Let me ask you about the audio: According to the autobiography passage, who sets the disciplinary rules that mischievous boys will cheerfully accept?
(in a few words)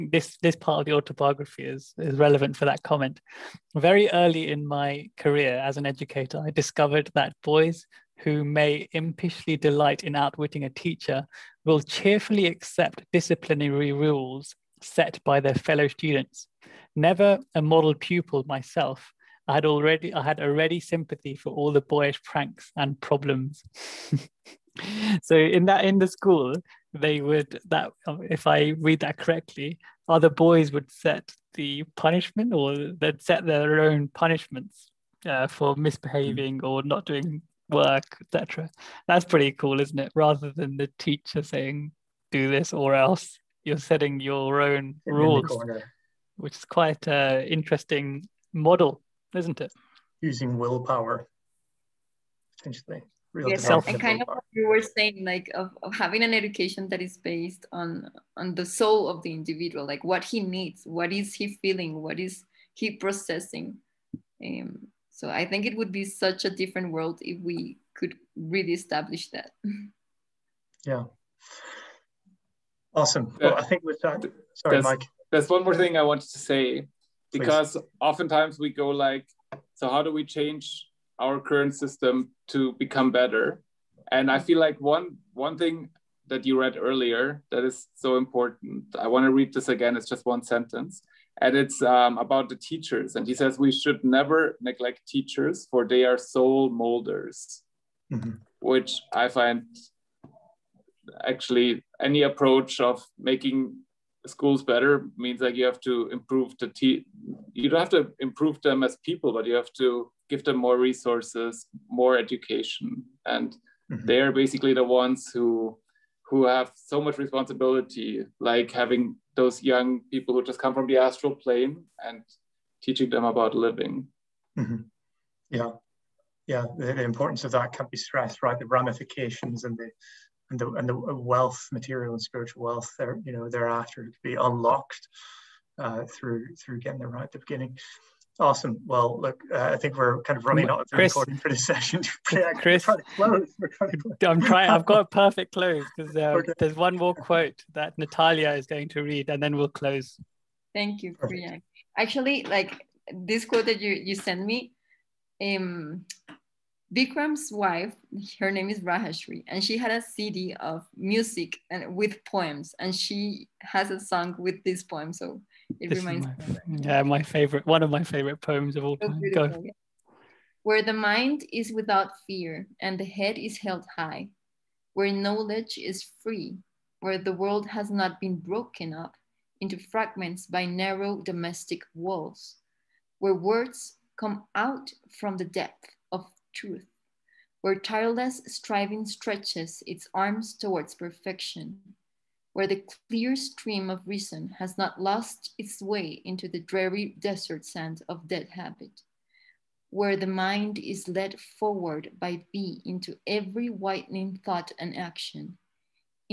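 Fellow students.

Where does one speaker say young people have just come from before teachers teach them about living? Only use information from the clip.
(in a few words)
The astral plane.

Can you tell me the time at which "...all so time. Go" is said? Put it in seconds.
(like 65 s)
168 s.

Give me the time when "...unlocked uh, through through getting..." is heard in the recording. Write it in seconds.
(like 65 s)
134 s.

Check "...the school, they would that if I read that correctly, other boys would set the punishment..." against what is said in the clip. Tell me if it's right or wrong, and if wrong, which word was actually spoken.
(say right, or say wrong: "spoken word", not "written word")
right.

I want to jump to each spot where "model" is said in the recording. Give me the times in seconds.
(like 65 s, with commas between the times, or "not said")
17 s, 48 s.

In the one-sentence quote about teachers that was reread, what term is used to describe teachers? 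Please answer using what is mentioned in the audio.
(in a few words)
Soul molders.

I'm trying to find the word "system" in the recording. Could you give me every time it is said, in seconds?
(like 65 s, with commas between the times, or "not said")
81 s.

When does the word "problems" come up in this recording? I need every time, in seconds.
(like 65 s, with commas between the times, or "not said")
23 s.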